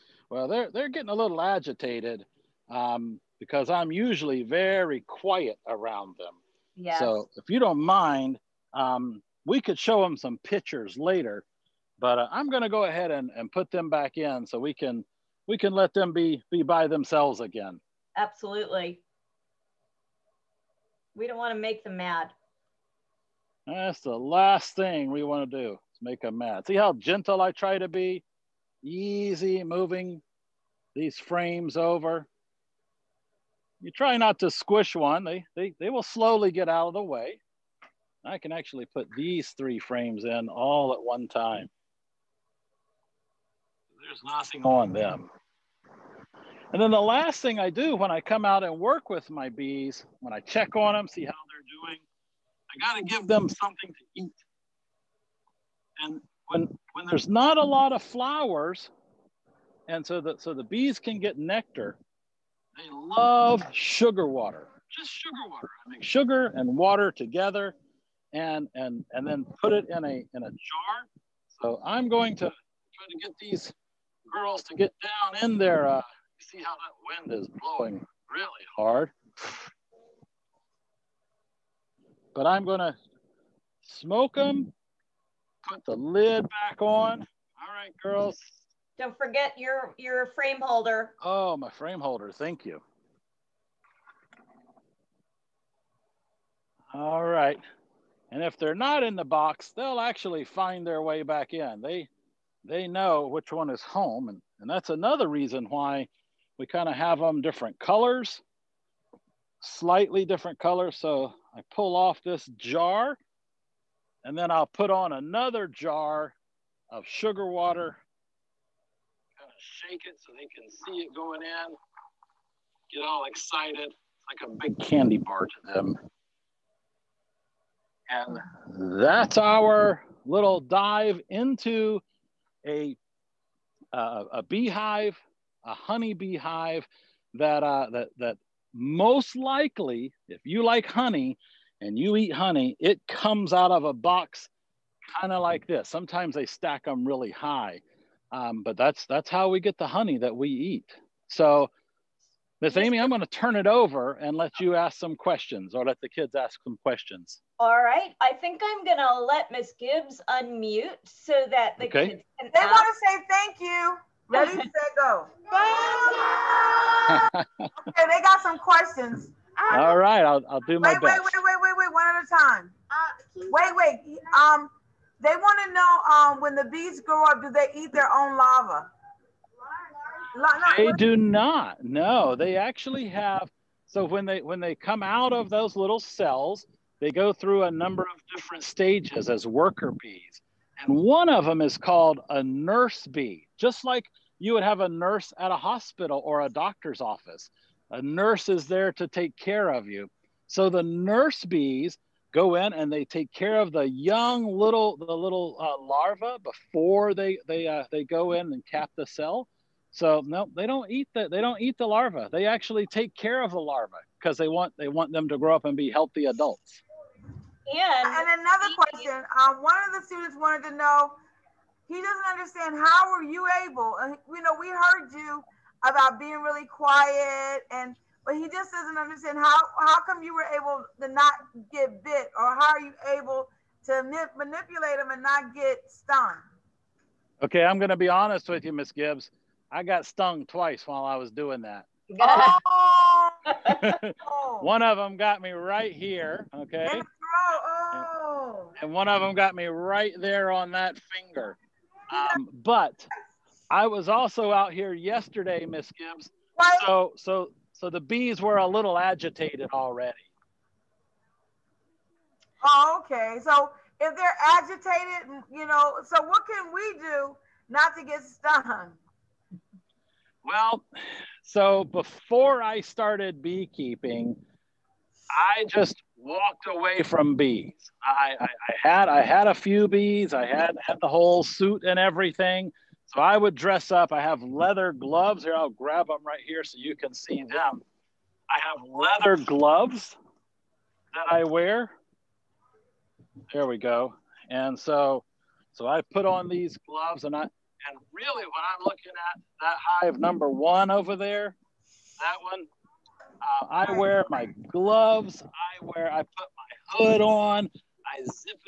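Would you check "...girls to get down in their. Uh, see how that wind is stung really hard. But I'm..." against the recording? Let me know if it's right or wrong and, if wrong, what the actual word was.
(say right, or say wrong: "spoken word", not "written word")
wrong: "blowing", not "stung".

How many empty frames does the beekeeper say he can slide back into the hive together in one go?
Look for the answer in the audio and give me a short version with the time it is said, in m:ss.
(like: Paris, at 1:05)
3, at 0:39.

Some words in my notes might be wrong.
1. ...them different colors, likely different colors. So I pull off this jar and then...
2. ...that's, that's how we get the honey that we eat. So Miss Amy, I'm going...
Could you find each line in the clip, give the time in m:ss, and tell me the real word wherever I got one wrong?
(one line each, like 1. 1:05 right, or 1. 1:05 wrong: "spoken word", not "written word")
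1. 1:47 wrong: "slightly", not "likely"
2. 2:28 right.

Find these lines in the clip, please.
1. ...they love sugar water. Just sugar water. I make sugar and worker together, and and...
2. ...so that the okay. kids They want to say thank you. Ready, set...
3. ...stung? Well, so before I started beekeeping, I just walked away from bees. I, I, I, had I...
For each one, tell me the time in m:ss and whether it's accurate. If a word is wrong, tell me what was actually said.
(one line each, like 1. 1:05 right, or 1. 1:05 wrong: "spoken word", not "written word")
1. 1:02 wrong: "water", not "worker"
2. 2:41 right
3. 4:28 right.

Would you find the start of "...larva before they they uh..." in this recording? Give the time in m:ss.
3:25.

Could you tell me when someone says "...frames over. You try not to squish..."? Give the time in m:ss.
0:31.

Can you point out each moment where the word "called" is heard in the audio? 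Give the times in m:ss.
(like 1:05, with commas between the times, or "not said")
3:11.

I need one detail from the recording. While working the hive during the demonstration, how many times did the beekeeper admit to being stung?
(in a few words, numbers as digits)
2.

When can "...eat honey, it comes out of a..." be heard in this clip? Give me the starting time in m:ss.
2:22.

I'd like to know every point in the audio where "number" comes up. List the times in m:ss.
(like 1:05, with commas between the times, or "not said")
3:07, 5:00.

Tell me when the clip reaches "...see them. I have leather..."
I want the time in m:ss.
4:47.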